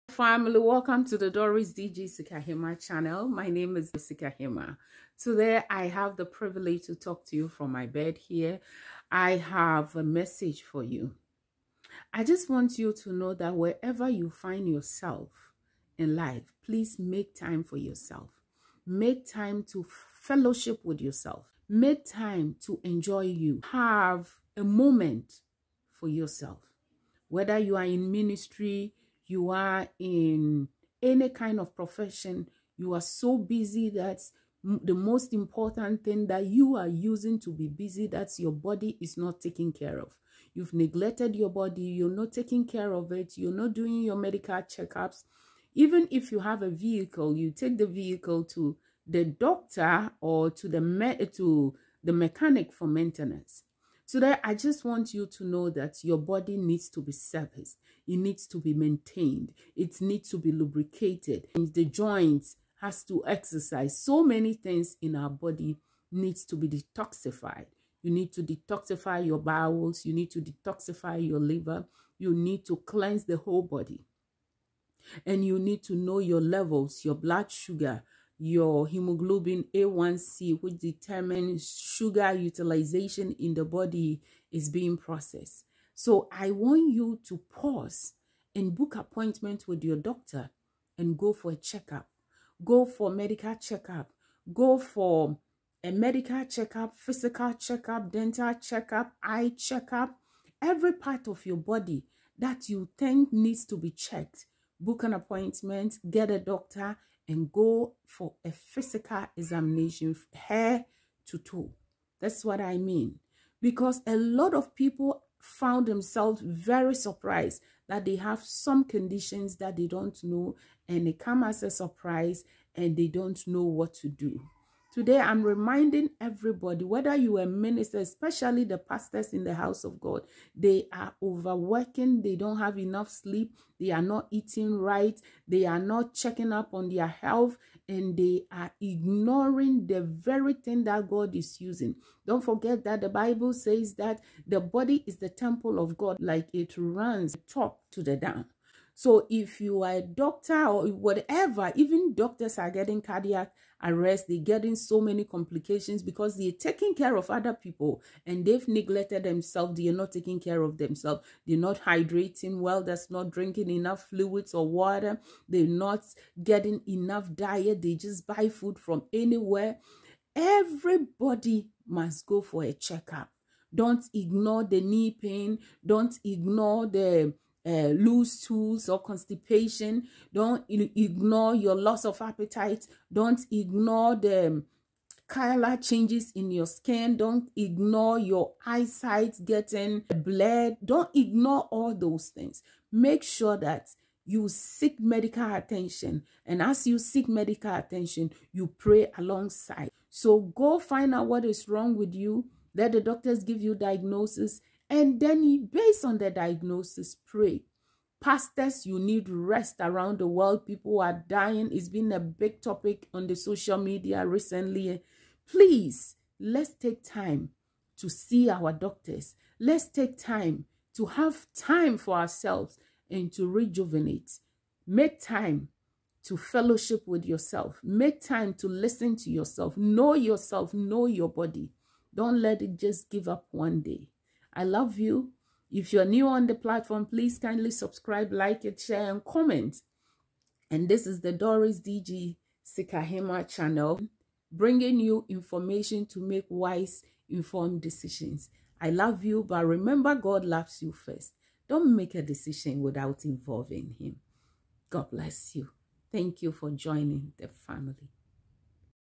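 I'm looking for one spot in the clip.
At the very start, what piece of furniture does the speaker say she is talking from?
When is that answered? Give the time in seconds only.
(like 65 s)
7 s.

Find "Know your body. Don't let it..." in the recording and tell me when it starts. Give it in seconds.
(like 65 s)
230 s.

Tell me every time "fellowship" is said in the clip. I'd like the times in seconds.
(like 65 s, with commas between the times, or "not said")
20 s, 226 s.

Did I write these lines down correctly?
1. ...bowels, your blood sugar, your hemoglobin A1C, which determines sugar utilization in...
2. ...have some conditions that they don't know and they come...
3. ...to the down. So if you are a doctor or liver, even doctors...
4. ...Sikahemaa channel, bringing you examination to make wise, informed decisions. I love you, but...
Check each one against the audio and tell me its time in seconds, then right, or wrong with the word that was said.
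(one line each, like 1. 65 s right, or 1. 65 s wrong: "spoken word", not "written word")
1. 76 s wrong: "levels", not "bowels"
2. 118 s right
3. 147 s wrong: "whatever", not "liver"
4. 242 s wrong: "information", not "examination".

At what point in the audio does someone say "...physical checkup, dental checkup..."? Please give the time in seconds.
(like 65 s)
96 s.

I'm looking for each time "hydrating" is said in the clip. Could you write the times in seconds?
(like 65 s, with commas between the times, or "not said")
161 s.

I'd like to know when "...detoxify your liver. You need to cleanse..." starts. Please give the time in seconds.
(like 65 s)
70 s.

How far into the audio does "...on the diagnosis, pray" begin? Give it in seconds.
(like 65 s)
206 s.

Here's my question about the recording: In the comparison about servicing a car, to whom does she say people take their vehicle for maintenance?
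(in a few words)
the mechanic.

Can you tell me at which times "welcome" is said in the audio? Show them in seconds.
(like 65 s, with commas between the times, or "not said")
0 s.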